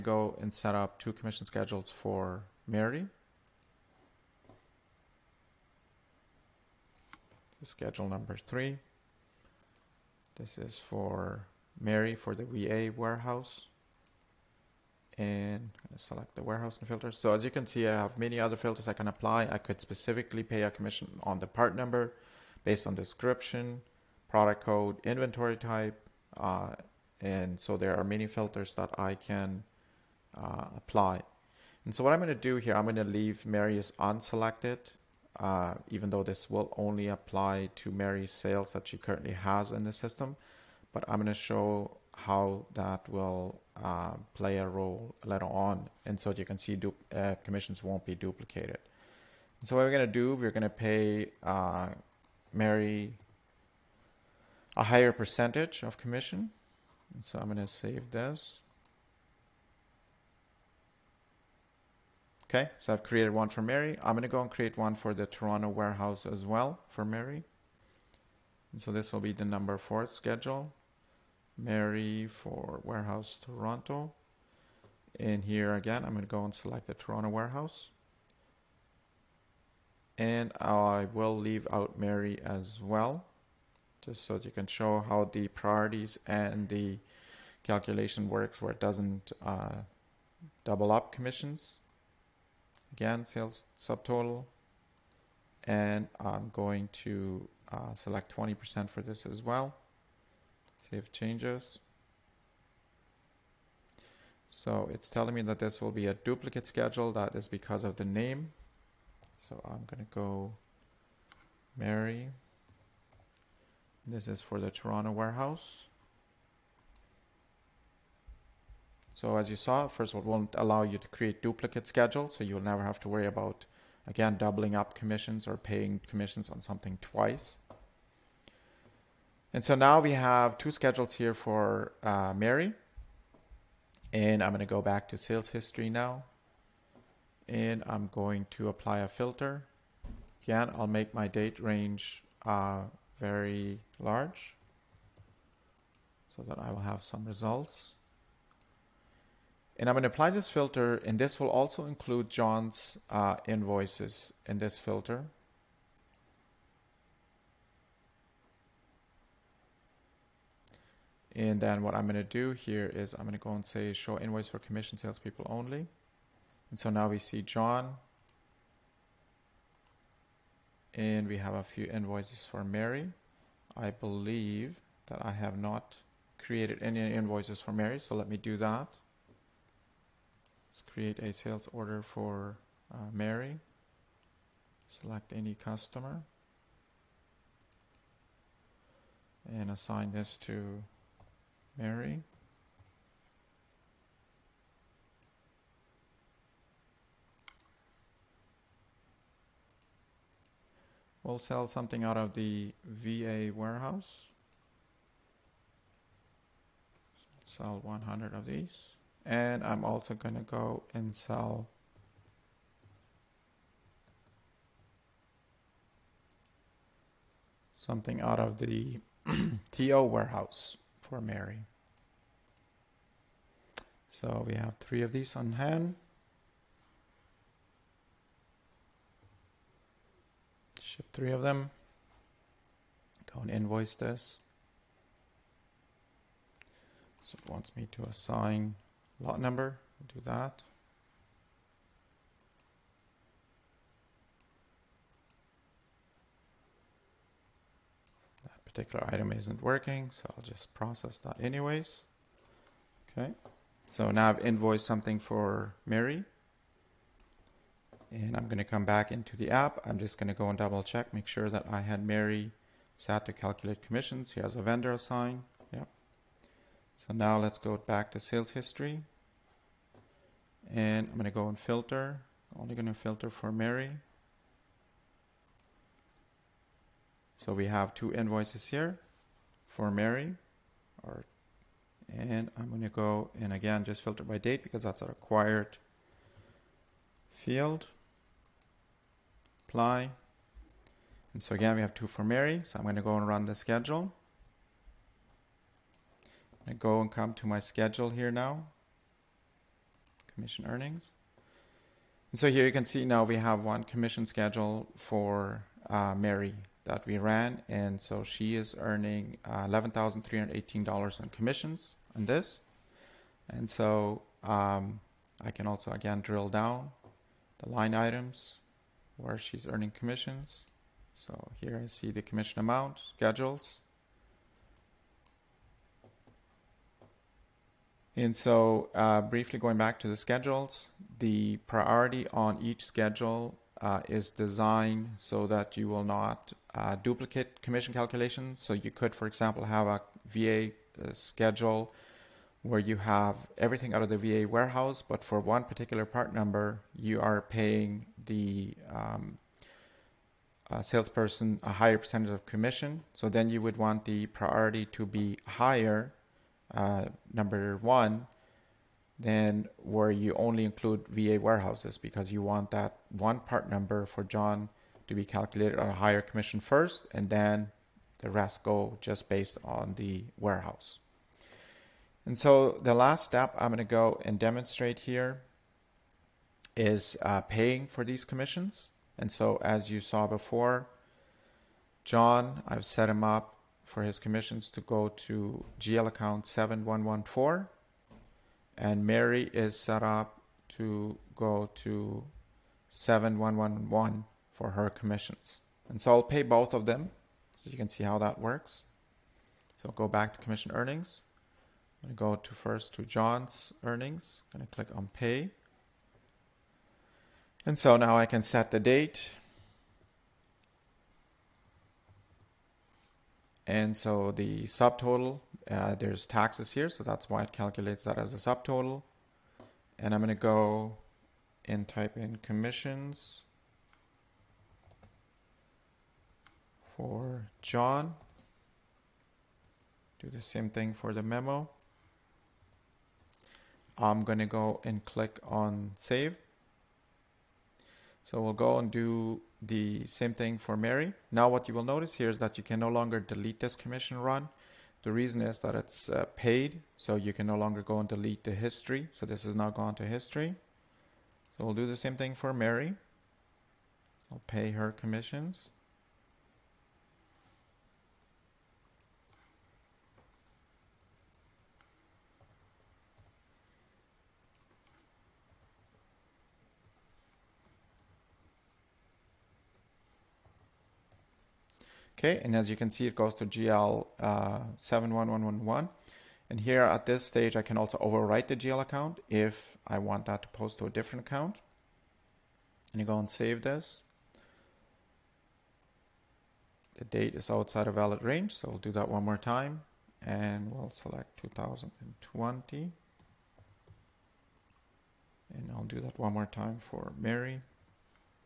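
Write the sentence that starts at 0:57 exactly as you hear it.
And so I'm going to save this.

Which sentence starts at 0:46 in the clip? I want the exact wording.
And so you can see uh, commissions won't be duplicated.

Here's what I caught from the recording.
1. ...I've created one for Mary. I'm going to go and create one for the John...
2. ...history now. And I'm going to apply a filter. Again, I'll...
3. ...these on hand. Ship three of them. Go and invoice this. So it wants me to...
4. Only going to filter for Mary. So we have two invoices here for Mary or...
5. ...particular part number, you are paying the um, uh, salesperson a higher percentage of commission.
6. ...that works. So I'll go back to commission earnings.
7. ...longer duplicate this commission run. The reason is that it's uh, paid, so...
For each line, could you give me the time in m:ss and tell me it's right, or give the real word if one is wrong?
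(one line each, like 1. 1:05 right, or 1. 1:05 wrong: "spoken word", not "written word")
1. 1:02 wrong: "Toronto", not "John"
2. 2:15 right
3. 3:45 right
4. 4:32 right
5. 5:45 right
6. 6:38 right
7. 7:22 wrong: "delete", not "duplicate".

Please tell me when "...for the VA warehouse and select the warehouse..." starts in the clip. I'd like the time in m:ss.
0:12.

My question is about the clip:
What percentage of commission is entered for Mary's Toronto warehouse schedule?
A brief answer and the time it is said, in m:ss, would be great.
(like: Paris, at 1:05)
20%, at 1:38.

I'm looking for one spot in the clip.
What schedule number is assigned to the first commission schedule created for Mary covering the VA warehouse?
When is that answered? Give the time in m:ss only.
0:07.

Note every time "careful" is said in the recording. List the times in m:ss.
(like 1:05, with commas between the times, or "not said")
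not said.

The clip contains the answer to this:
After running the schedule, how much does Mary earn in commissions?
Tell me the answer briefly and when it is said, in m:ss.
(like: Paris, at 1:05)
$11,318, at 5:09.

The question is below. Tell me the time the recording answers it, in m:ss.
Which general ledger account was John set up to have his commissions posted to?
6:26.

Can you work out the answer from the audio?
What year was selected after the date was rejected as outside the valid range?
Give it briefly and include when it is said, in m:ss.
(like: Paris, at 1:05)
2020, at 8:11.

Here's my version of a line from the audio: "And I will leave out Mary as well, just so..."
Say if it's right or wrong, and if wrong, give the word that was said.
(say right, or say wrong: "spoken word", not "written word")
right.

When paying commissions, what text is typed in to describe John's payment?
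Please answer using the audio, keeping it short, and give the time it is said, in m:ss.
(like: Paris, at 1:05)
commissions for John, at 7:02.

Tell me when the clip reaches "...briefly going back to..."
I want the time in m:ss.
5:29.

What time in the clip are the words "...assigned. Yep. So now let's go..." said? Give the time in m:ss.
4:24.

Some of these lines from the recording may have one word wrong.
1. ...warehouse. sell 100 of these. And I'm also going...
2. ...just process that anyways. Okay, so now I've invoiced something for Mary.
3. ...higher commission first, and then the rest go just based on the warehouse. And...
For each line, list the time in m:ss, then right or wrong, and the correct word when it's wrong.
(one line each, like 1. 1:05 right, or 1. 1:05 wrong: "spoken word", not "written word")
1. 3:23 right
2. 4:10 right
3. 6:05 right.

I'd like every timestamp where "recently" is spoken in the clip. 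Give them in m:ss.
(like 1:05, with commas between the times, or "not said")
not said.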